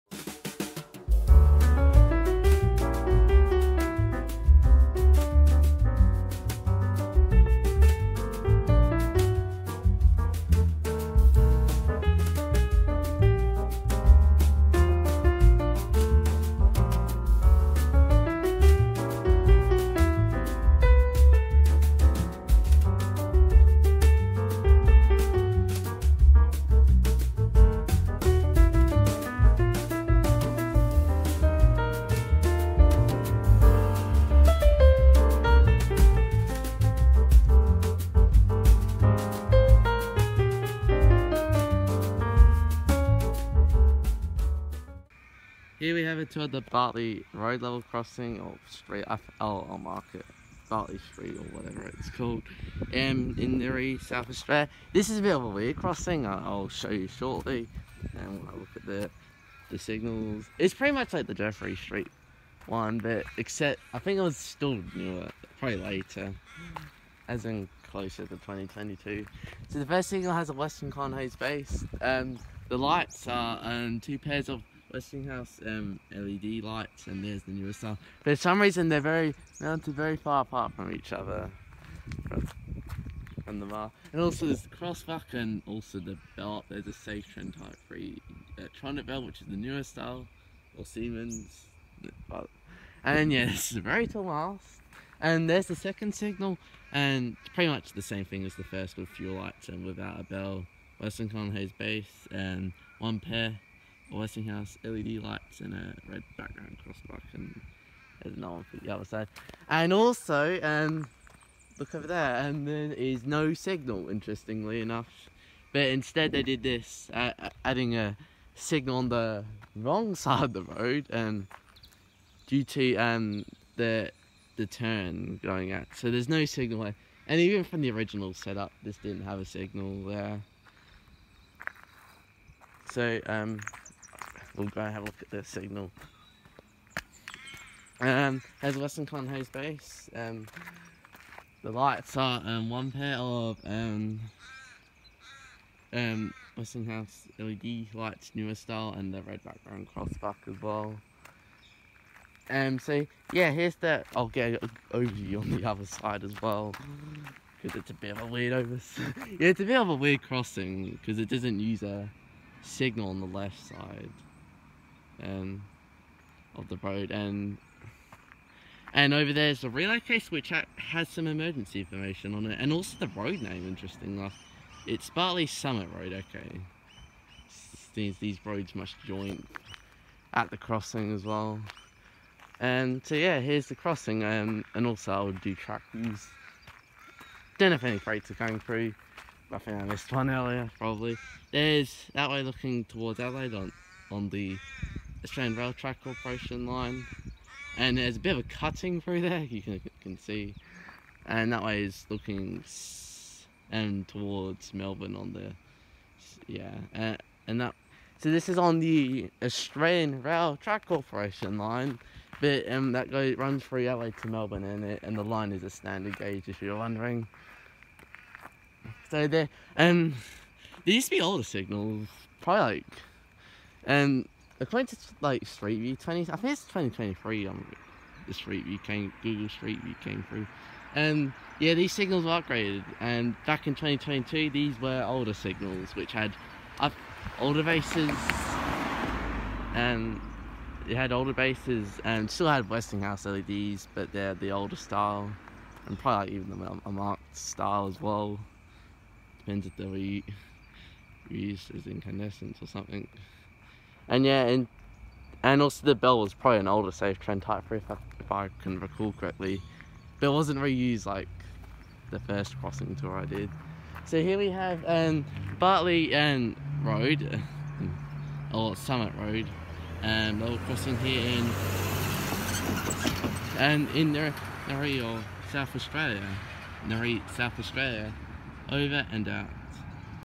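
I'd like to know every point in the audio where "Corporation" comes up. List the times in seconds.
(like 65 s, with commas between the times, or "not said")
196 s, 210 s.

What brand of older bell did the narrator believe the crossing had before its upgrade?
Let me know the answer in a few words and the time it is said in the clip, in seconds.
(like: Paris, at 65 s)
Safetran, at 256 s.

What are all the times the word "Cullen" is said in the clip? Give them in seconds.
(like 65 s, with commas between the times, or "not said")
70 s, 101 s, 139 s.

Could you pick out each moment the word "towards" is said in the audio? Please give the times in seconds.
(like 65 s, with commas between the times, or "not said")
46 s, 192 s, 204 s.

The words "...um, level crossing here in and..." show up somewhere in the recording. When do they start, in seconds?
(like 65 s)
270 s.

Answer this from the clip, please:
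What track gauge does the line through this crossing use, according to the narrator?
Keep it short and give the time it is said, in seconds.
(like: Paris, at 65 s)
Standard gauge, at 215 s.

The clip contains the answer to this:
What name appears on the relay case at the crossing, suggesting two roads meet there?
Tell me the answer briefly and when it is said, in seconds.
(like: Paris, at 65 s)
Bartley Summit Road, at 175 s.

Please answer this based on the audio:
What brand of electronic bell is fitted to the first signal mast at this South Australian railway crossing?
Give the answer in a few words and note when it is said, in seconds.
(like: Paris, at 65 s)
Trend Type 3, at 87 s.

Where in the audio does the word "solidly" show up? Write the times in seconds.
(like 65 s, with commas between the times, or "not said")
not said.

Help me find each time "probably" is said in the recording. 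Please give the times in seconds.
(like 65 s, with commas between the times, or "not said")
65 s, 190 s, 222 s, 245 s, 256 s.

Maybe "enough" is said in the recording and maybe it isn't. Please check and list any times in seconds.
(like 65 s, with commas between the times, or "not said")
114 s, 174 s.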